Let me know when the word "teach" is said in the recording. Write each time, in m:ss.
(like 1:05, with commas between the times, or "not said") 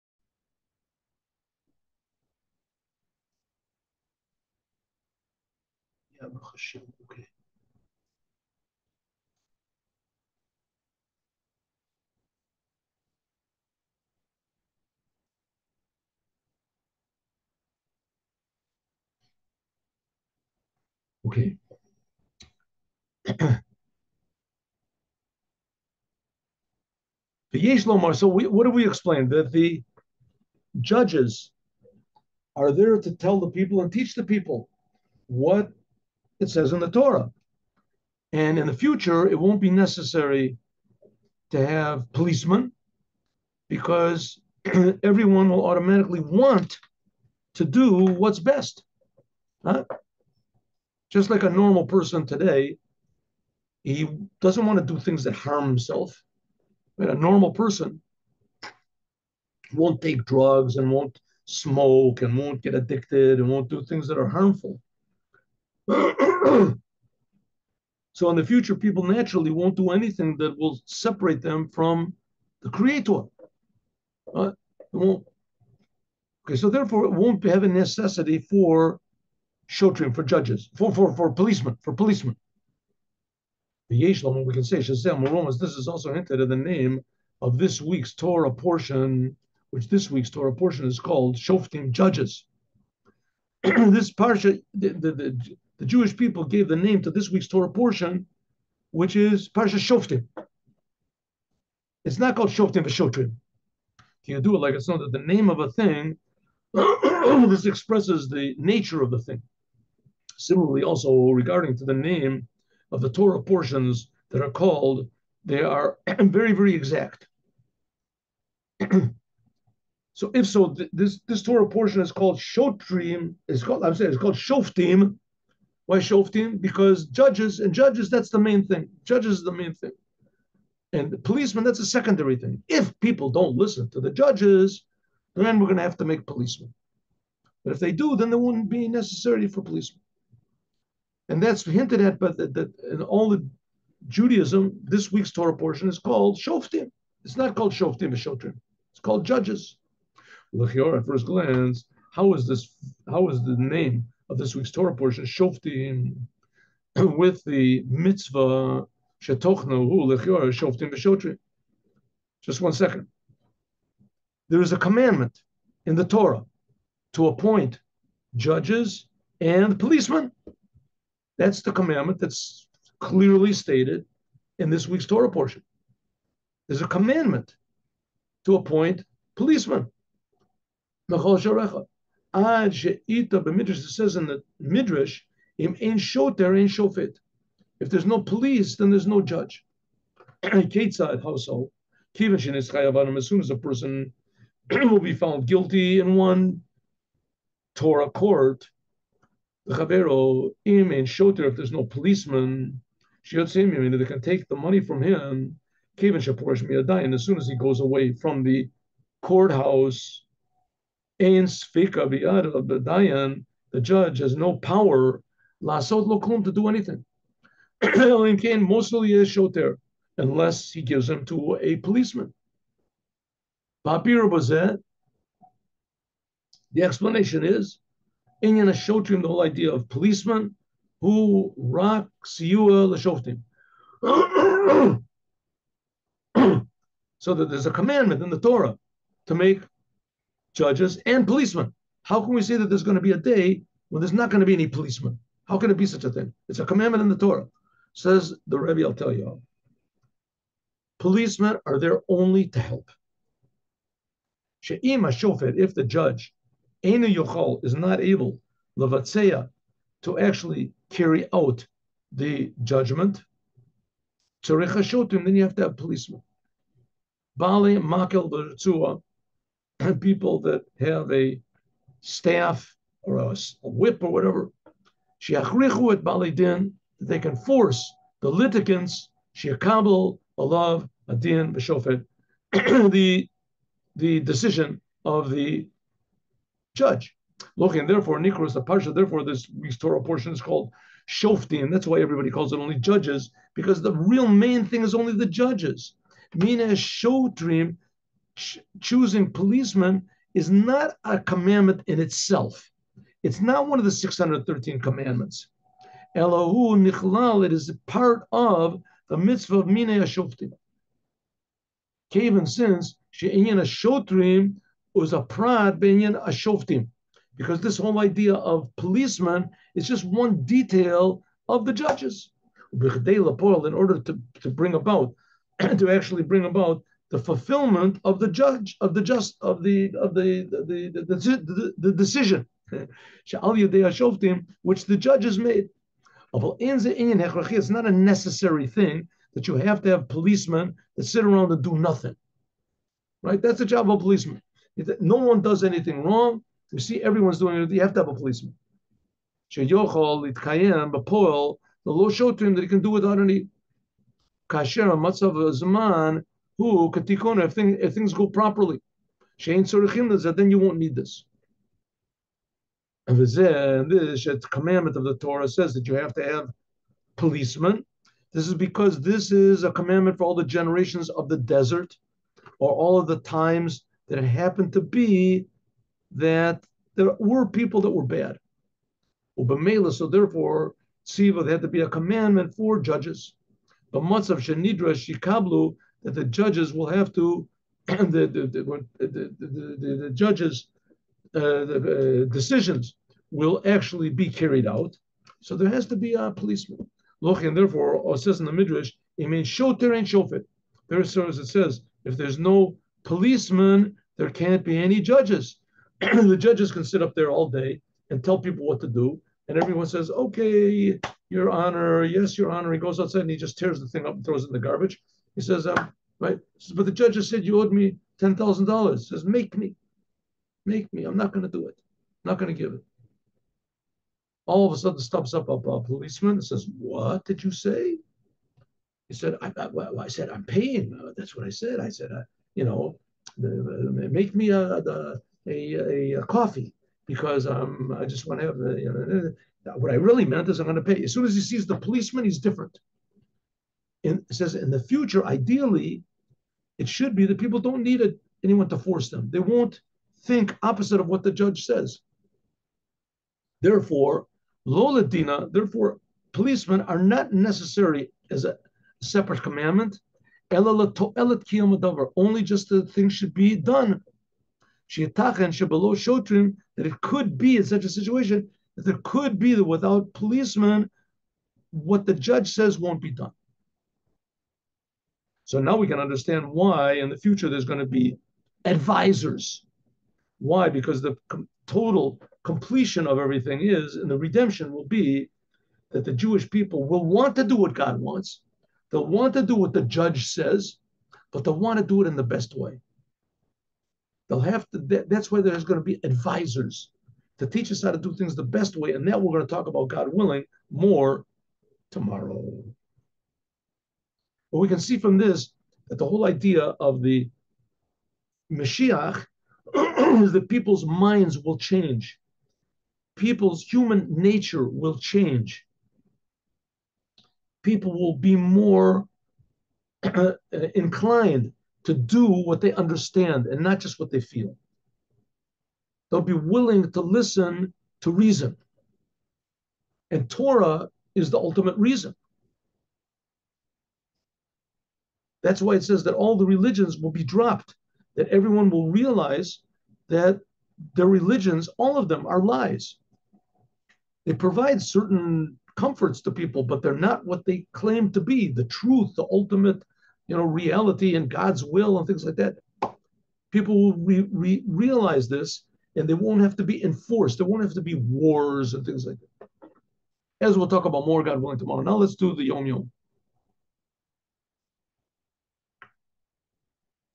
0:33, 8:17.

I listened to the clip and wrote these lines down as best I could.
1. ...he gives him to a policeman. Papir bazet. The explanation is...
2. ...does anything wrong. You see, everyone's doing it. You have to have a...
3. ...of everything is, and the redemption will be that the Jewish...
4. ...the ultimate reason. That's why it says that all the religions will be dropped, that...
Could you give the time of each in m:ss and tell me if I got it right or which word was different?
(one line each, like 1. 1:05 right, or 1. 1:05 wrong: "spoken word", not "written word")
1. 3:40 right
2. 5:45 right
3. 8:03 right
4. 8:51 right.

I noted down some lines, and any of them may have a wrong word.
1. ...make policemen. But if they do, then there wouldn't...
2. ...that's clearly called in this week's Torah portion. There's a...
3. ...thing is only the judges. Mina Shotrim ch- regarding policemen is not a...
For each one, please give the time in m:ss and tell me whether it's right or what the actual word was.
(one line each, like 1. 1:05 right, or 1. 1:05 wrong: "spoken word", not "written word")
1. 2:16 right
2. 2:52 wrong: "stated", not "called"
3. 4:54 wrong: "choosing", not "regarding".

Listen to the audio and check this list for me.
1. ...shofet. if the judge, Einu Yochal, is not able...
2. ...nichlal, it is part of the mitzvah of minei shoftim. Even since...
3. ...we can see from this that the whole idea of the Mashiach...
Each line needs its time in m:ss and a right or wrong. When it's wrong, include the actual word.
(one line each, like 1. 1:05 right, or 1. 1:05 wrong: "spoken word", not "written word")
1. 4:15 right
2. 5:06 right
3. 8:24 right.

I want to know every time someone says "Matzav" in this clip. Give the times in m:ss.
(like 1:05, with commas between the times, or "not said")
5:54, 6:24.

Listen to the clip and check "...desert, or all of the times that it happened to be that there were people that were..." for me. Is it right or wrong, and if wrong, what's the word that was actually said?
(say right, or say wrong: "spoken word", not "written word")
right.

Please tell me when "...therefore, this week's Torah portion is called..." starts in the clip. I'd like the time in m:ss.
4:48.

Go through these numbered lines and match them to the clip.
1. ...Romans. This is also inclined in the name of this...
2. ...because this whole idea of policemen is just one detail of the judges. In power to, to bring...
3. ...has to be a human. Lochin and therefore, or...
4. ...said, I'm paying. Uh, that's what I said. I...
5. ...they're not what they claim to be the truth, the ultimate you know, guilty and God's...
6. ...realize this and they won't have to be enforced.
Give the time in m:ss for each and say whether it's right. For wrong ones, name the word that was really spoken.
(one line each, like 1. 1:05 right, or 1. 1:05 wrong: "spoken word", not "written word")
1. 1:25 wrong: "hinted", not "inclined"
2. 5:17 wrong: "order", not "power"
3. 6:35 wrong: "policeman", not "human"
4. 7:10 right
5. 9:06 wrong: "reality", not "guilty"
6. 9:14 right.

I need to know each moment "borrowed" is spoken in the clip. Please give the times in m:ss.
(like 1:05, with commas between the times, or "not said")
not said.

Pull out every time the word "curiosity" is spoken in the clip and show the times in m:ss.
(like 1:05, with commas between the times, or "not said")
not said.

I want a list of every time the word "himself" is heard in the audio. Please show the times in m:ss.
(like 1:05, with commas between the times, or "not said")
0:55.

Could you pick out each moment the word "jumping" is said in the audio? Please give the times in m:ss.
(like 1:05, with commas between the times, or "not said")
not said.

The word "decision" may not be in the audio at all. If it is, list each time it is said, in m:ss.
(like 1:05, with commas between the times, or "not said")
4:44, 5:31, 6:32.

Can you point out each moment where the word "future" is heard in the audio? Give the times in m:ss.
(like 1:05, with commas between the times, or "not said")
0:38, 1:08, 7:24, 7:57.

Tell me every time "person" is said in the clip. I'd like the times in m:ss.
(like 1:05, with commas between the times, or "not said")
0:51, 0:57, 3:13.